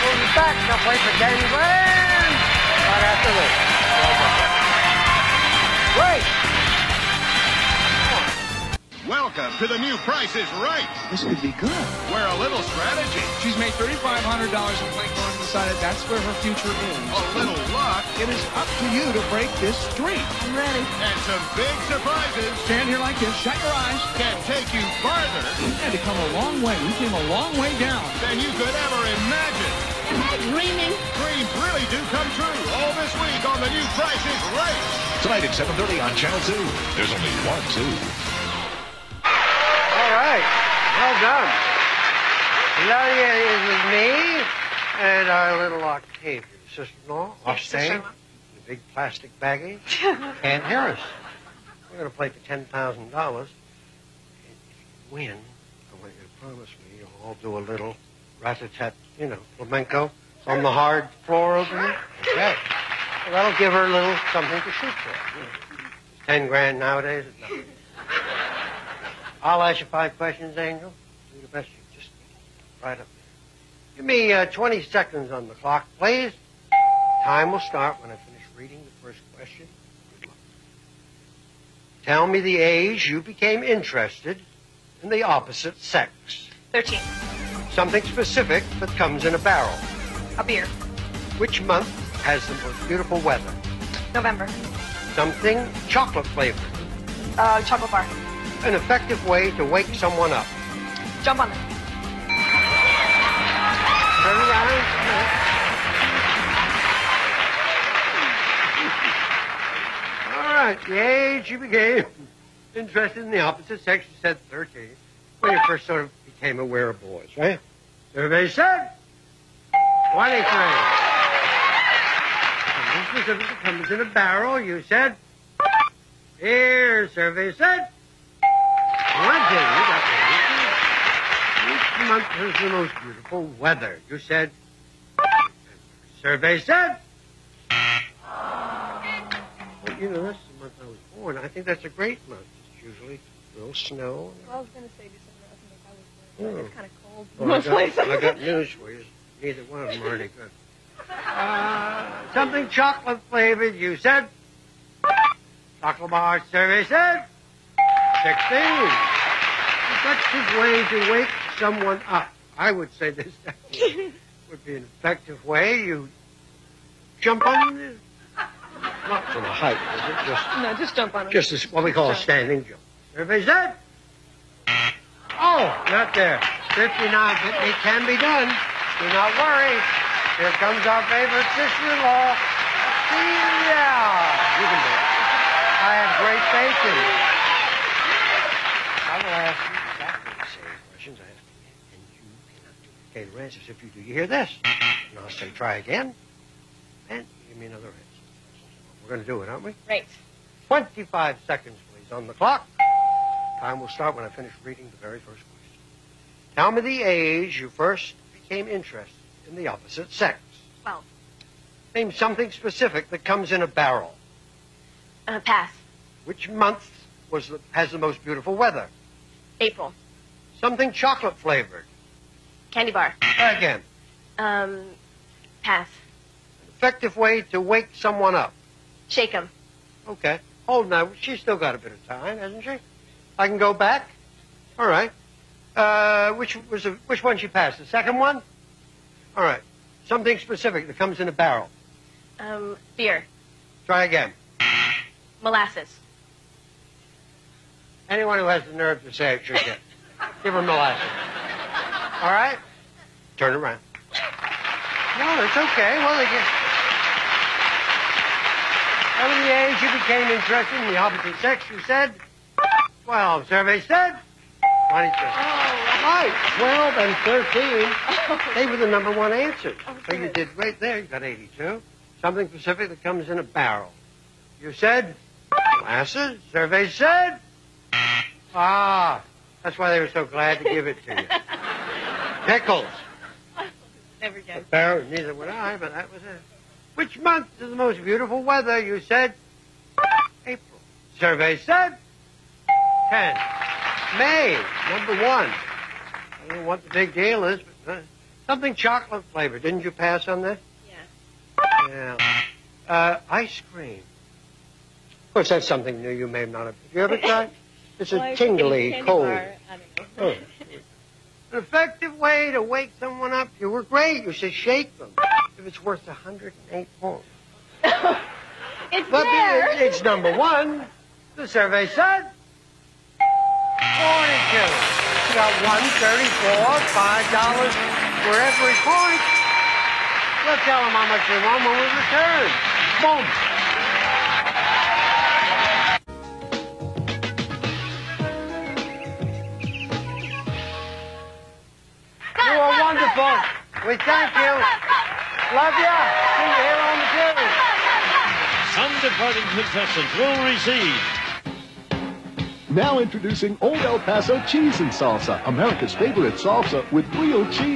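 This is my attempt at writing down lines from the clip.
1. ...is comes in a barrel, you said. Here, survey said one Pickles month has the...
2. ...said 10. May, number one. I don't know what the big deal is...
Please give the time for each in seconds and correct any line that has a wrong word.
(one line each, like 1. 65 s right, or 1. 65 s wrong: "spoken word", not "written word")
1. 123 s wrong: "Each", not "Pickles"
2. 291 s right.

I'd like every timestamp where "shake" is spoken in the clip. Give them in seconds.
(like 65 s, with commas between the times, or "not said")
229 s, 314 s.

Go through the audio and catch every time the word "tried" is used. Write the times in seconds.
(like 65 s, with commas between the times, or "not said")
307 s.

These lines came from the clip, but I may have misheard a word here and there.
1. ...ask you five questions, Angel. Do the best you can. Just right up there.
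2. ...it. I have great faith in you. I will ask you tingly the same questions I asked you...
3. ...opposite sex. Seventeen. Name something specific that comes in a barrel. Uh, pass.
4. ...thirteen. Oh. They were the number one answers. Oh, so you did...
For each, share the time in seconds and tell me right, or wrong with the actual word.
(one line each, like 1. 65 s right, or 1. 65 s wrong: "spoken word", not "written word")
1. 69 s right
2. 184 s wrong: "exactly", not "tingly"
3. 209 s wrong: "Twelve", not "Seventeen"
4. 267 s right.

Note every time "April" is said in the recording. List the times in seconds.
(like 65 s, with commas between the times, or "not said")
219 s, 290 s.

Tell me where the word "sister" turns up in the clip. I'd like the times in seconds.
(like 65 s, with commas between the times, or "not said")
46 s, 181 s.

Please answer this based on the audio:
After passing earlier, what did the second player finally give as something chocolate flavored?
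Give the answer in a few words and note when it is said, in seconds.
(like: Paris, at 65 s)
Ice cream, at 303 s.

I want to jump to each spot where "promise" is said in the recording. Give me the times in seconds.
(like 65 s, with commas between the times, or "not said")
56 s.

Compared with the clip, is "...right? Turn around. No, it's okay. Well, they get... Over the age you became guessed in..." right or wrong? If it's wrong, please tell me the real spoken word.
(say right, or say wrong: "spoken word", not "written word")
wrong: "interested", not "guessed".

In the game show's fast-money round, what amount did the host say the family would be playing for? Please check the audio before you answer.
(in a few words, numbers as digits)
$10,000.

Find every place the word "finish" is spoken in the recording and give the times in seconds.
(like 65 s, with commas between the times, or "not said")
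78 s, 204 s.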